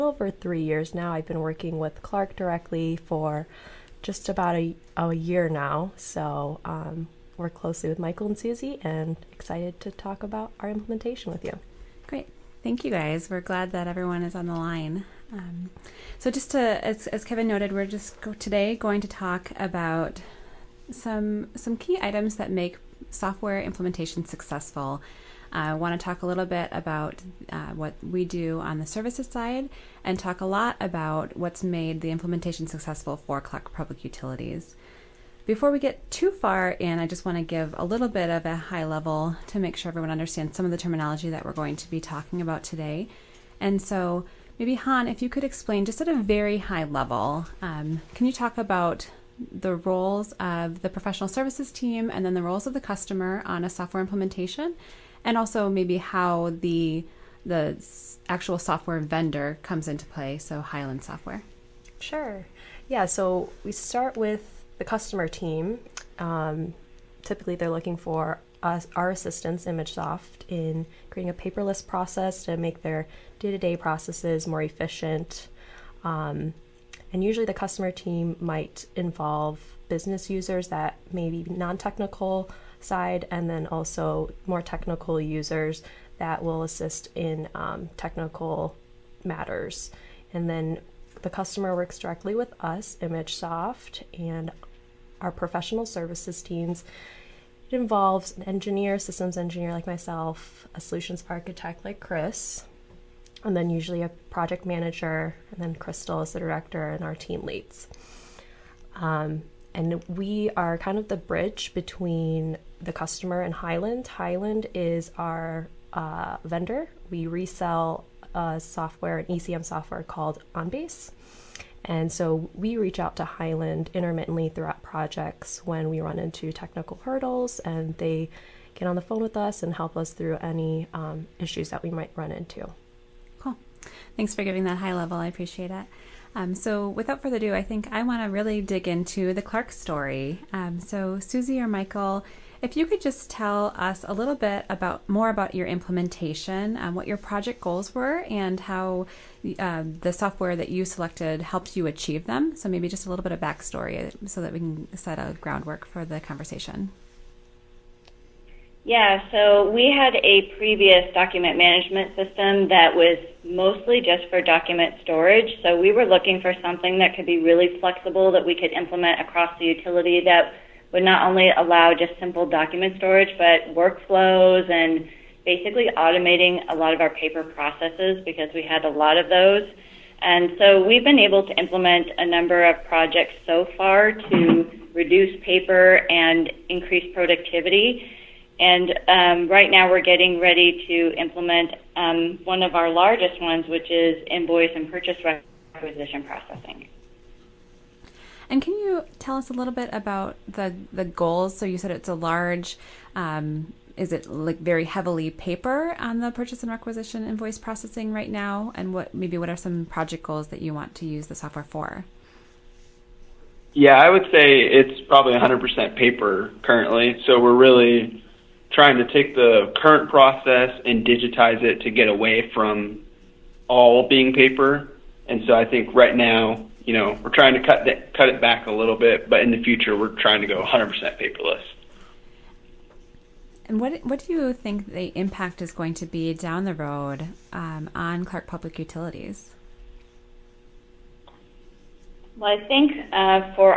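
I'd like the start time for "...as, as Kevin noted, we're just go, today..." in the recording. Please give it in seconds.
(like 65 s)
16 s.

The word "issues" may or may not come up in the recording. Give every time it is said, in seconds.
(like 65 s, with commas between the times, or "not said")
131 s.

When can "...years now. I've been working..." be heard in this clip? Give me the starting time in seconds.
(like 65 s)
0 s.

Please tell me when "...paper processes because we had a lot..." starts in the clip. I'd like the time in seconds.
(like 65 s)
177 s.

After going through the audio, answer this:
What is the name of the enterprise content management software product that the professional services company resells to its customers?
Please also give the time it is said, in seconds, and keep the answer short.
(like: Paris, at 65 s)
OnBase, at 120 s.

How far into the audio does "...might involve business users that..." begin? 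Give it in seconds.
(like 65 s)
78 s.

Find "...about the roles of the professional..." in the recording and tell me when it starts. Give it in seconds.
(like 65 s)
48 s.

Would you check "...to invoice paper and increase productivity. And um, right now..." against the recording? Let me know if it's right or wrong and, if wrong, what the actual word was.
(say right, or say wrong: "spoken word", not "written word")
wrong: "reduce", not "invoice".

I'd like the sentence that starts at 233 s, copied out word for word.
And what what do you think the impact is going to be down the road um, on Clark Public Utilities?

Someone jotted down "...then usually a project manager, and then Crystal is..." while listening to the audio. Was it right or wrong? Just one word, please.
right.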